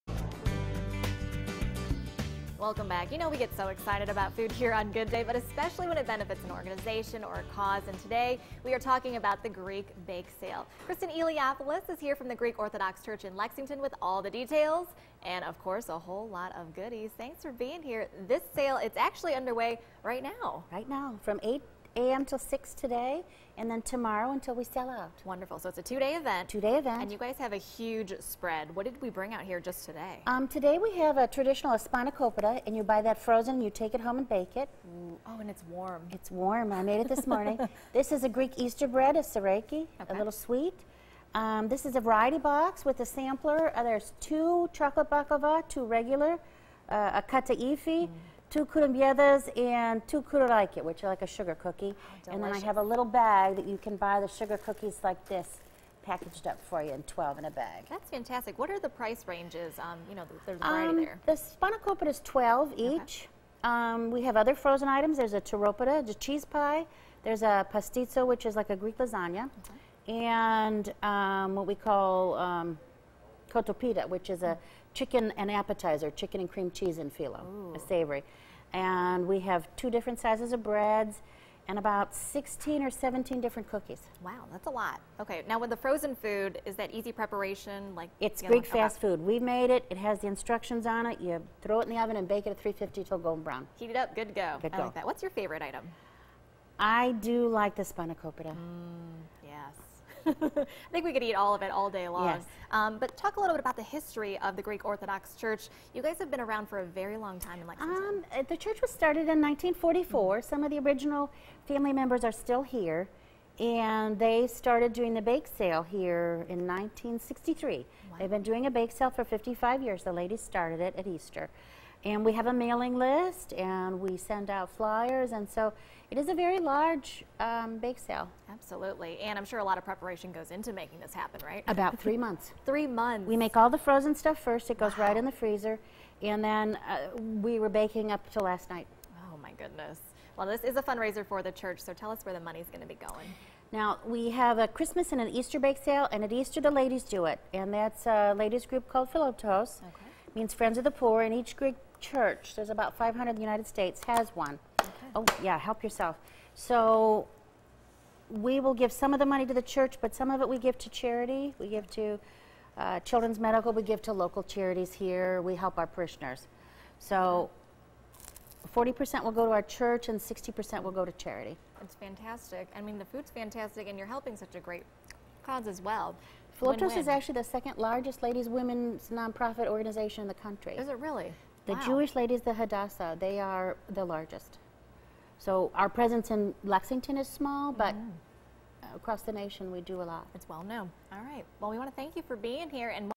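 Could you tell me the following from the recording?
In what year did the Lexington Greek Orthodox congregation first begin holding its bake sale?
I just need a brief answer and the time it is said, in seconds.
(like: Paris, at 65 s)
1963, at 116 s.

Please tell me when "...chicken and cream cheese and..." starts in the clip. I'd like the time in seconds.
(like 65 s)
76 s.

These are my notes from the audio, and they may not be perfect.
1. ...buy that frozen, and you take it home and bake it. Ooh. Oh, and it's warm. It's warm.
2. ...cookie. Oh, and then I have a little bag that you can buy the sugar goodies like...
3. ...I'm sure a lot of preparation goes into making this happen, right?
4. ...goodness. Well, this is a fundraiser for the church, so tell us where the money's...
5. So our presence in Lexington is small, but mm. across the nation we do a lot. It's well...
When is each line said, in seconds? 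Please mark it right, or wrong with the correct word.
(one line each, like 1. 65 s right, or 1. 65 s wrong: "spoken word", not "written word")
1. 32 s right
2. 51 s wrong: "cookies", not "goodies"
3. 129 s right
4. 139 s right
5. 185 s right.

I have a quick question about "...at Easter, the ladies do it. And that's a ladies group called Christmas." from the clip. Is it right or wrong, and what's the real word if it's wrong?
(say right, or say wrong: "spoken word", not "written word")
wrong: "Philoptochos", not "Christmas".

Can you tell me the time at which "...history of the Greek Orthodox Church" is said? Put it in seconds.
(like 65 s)
103 s.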